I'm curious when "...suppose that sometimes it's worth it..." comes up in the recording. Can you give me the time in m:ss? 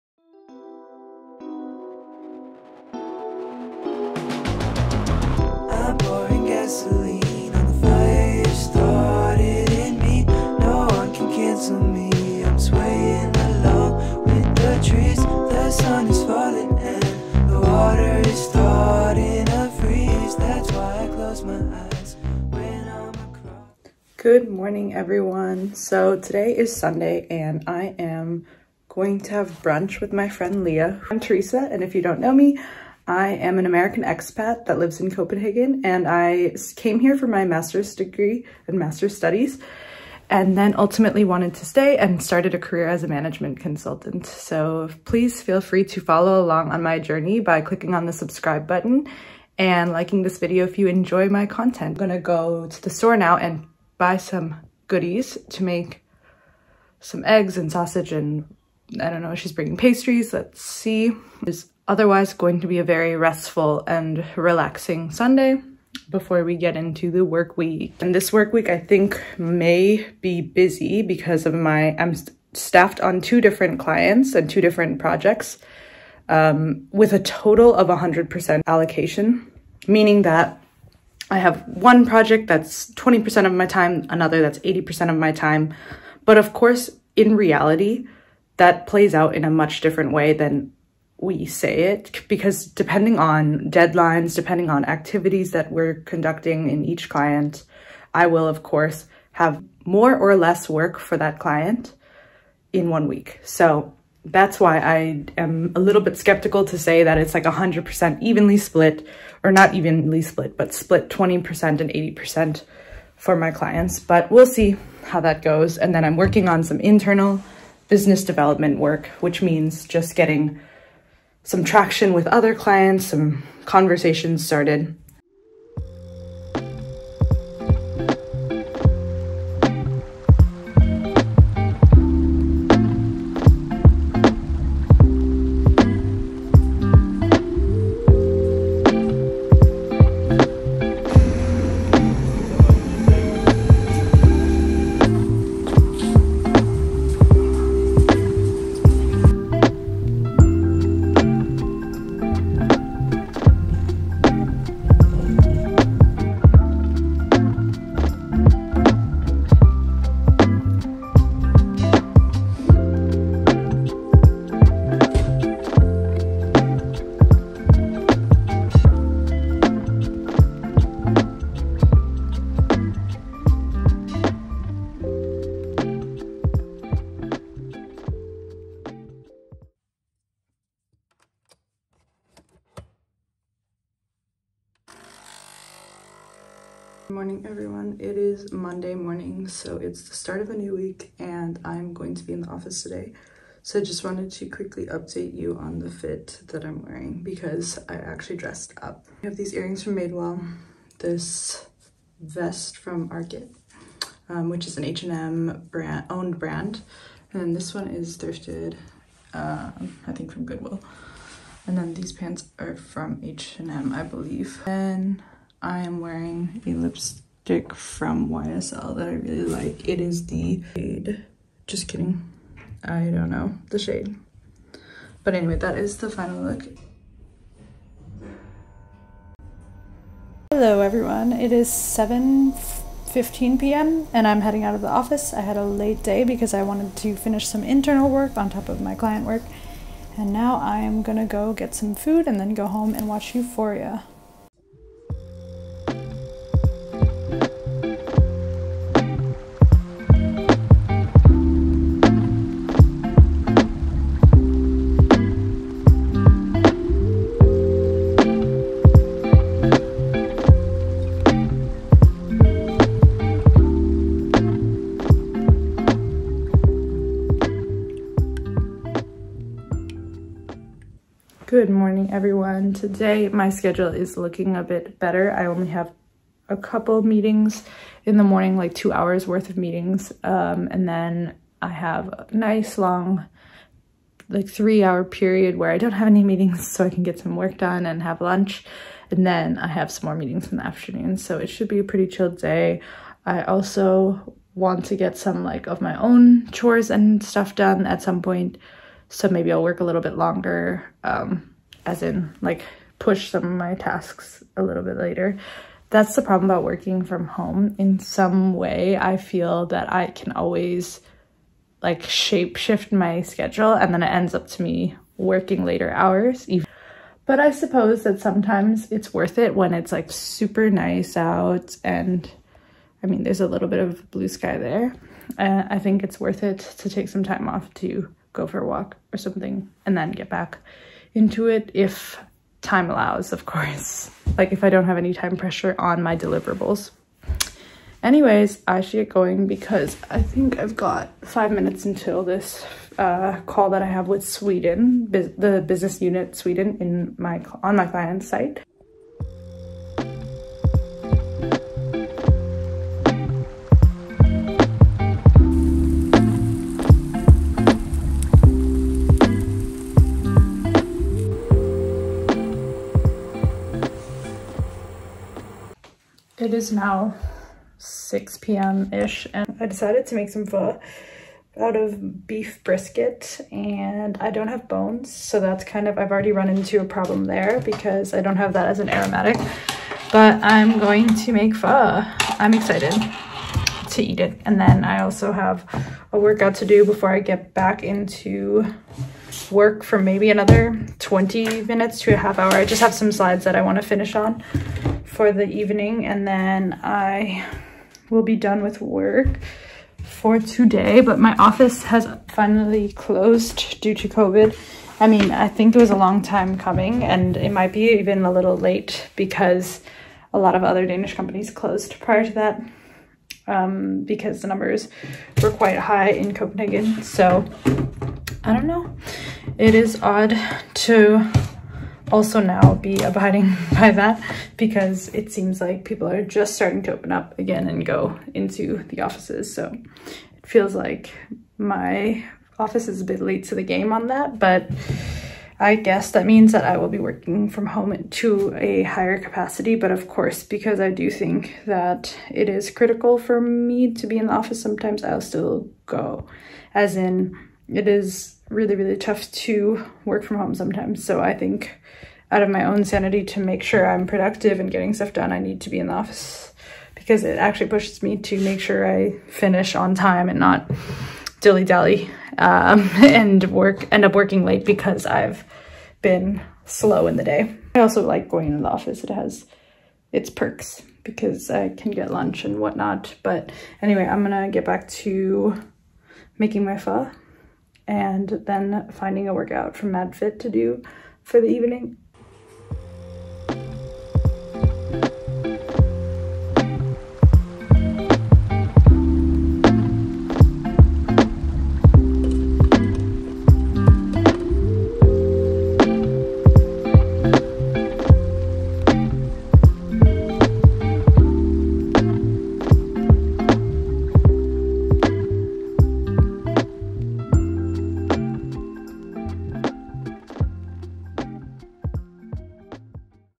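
5:17.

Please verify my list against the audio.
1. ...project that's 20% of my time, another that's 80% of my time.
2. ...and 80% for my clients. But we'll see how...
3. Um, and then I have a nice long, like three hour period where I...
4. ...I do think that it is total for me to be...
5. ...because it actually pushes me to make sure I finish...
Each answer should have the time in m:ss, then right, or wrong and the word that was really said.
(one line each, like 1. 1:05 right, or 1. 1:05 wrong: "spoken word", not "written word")
1. 1:22 right
2. 1:51 right
3. 4:40 right
4. 7:20 wrong: "critical", not "total"
5. 7:36 right.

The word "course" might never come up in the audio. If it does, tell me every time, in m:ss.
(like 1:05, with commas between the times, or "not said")
1:26, 1:38, 5:33, 7:20.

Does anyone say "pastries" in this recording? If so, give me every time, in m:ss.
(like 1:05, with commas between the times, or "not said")
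0:59.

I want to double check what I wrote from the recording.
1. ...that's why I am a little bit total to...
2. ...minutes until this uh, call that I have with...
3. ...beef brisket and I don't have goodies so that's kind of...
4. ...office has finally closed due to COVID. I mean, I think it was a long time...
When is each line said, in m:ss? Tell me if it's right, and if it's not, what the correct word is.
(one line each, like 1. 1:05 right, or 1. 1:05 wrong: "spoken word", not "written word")
1. 1:44 wrong: "skeptical", not "total"
2. 5:41 right
3. 6:12 wrong: "bones", not "goodies"
4. 6:41 right.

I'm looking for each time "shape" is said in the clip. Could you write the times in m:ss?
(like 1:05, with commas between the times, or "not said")
5:12.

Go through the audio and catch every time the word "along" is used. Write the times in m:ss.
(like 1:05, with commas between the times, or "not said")
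0:46.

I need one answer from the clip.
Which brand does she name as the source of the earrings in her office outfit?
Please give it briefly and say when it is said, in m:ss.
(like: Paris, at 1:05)
Madewell, at 3:19.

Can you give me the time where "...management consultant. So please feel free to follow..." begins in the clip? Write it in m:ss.
0:43.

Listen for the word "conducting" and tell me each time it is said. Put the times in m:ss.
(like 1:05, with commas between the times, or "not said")
1:36.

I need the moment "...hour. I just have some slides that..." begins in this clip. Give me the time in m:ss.
6:32.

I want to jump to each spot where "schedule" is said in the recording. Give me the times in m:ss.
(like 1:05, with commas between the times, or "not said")
4:33, 5:13.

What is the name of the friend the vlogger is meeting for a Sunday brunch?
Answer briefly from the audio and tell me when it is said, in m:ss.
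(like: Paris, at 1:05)
Leah, at 0:30.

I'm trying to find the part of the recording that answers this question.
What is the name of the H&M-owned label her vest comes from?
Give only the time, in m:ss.
3:23.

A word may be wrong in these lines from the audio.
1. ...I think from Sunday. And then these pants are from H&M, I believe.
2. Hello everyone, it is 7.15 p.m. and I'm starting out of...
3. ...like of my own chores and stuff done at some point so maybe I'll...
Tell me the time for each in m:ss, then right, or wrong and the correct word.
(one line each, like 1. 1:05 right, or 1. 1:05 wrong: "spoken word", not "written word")
1. 3:30 wrong: "Goodwill", not "Sunday"
2. 3:50 wrong: "heading", not "starting"
3. 4:55 right.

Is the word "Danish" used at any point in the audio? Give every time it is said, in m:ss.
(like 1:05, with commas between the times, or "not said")
6:50.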